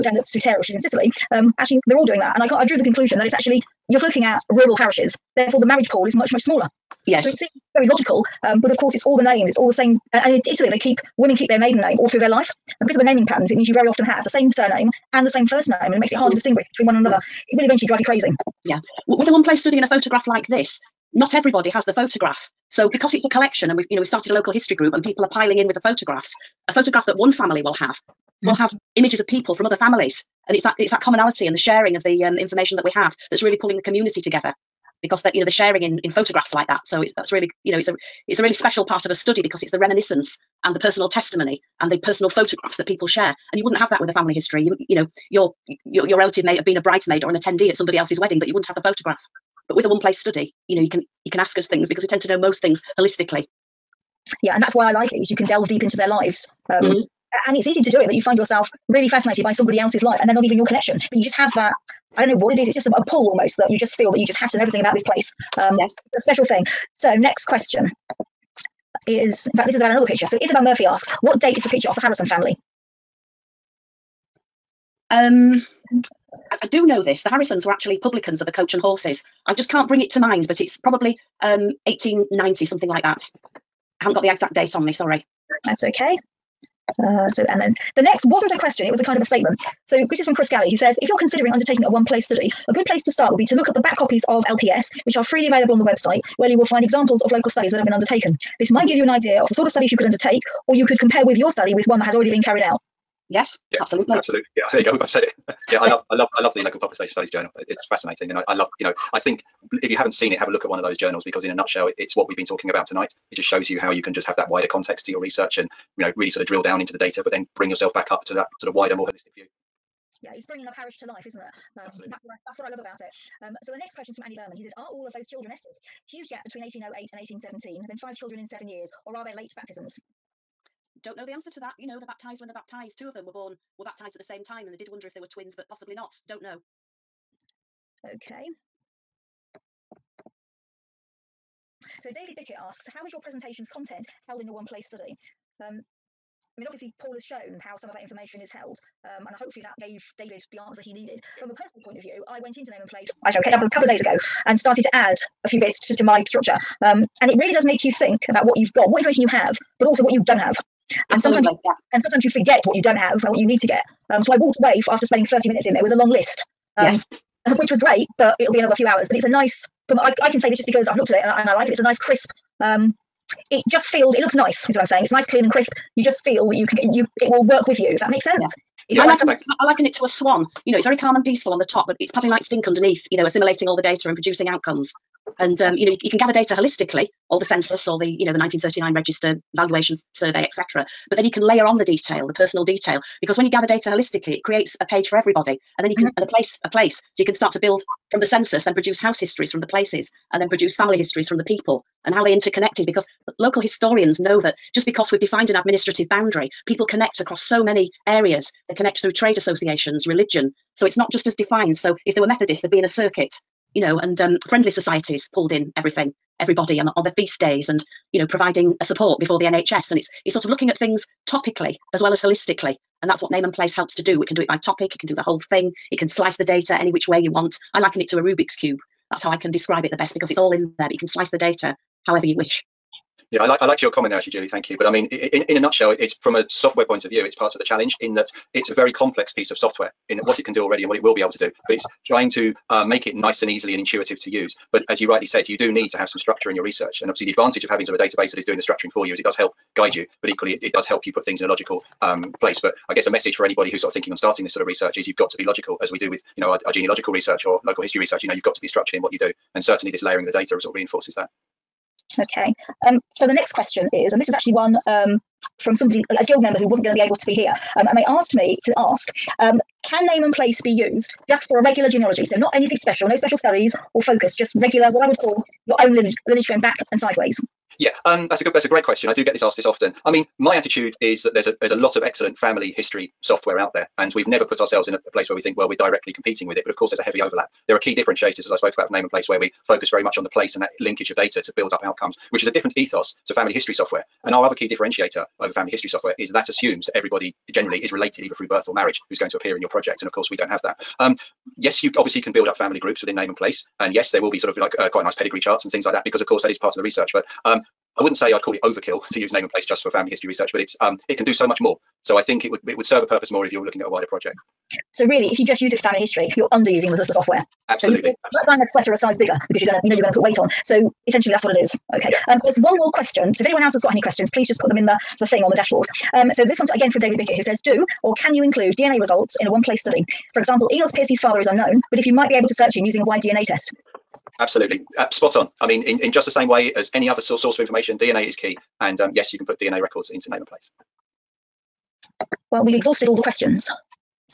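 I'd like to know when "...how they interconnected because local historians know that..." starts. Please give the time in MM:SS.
03:22.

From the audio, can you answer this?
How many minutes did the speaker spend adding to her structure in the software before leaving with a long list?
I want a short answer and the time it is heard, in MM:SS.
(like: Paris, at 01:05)
30, at 02:45.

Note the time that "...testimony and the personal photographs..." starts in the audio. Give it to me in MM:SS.
00:41.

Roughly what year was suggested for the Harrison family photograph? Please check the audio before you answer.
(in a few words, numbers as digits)
1890.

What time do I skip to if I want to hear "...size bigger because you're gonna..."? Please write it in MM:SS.
05:18.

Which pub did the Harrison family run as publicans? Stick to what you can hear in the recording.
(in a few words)
The Coach and Horses.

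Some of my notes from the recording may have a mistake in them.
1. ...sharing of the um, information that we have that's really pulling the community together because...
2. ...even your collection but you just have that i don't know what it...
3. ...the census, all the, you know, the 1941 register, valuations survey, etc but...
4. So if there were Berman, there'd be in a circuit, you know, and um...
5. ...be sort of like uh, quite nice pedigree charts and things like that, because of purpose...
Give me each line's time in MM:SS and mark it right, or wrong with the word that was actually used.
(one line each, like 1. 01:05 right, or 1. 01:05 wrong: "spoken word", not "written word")
1. 00:31 right
2. 01:00 wrong: "connection", not "collection"
3. 03:07 wrong: "1939", not "1941"
4. 03:31 wrong: "Methodists", not "Berman"
5. 05:04 wrong: "course", not "purpose".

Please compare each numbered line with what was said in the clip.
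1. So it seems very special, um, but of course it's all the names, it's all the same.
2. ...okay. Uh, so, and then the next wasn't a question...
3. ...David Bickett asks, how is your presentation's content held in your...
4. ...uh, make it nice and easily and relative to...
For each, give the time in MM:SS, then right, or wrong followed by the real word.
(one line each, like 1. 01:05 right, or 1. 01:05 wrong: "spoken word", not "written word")
1. 00:07 wrong: "logical", not "special"
2. 01:25 right
3. 02:22 right
4. 04:02 wrong: "intuitive", not "relative".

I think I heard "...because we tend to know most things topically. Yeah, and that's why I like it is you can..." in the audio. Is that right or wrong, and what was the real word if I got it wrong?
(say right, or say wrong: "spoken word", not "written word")
wrong: "holistically", not "topically".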